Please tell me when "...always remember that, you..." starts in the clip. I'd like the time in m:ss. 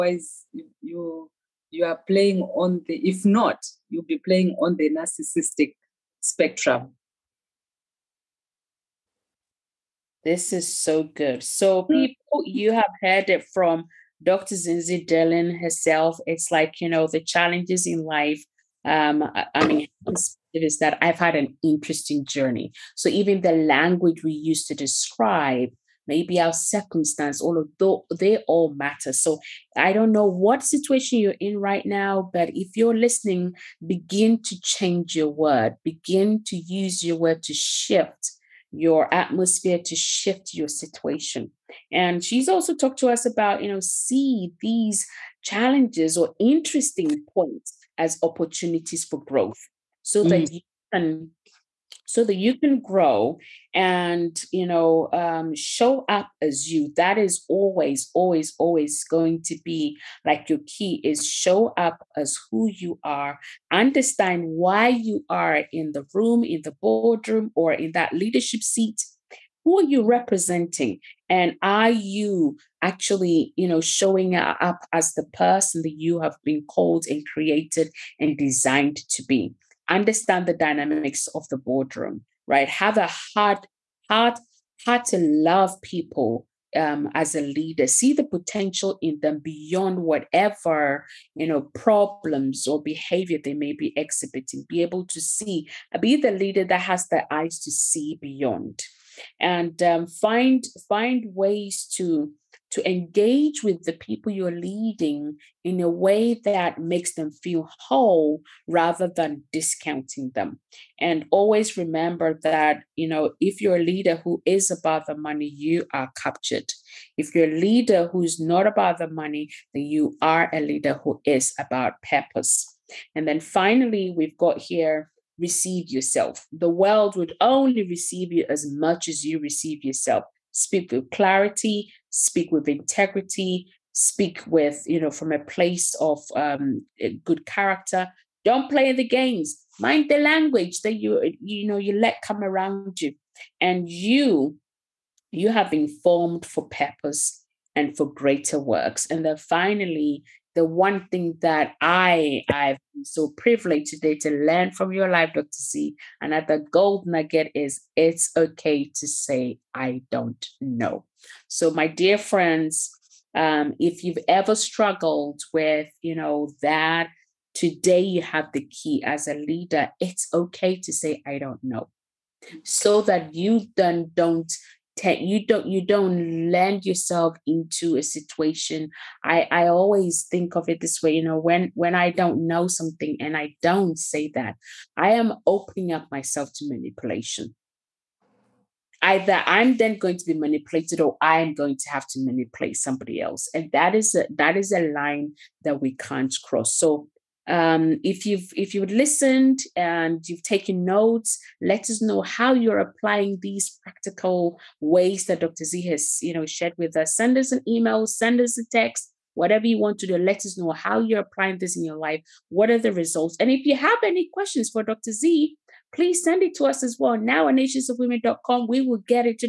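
1:51.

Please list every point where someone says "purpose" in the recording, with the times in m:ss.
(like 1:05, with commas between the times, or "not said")
2:02, 2:26.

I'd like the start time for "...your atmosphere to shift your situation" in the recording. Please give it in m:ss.
0:38.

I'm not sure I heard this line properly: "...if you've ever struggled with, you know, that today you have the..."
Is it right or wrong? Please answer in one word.
right.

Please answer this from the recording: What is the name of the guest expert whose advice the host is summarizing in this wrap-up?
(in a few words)
Dr. Zienzie Dillion.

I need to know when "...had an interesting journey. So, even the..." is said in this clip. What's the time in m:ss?
0:21.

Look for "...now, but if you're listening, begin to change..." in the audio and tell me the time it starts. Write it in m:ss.
0:31.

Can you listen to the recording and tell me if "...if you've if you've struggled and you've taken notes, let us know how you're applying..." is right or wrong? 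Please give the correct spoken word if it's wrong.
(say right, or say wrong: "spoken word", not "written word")
wrong: "listened", not "struggled".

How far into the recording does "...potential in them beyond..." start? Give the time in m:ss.
1:28.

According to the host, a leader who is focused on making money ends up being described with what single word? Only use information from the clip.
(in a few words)
Captured.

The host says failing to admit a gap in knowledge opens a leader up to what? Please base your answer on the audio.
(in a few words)
Manipulation.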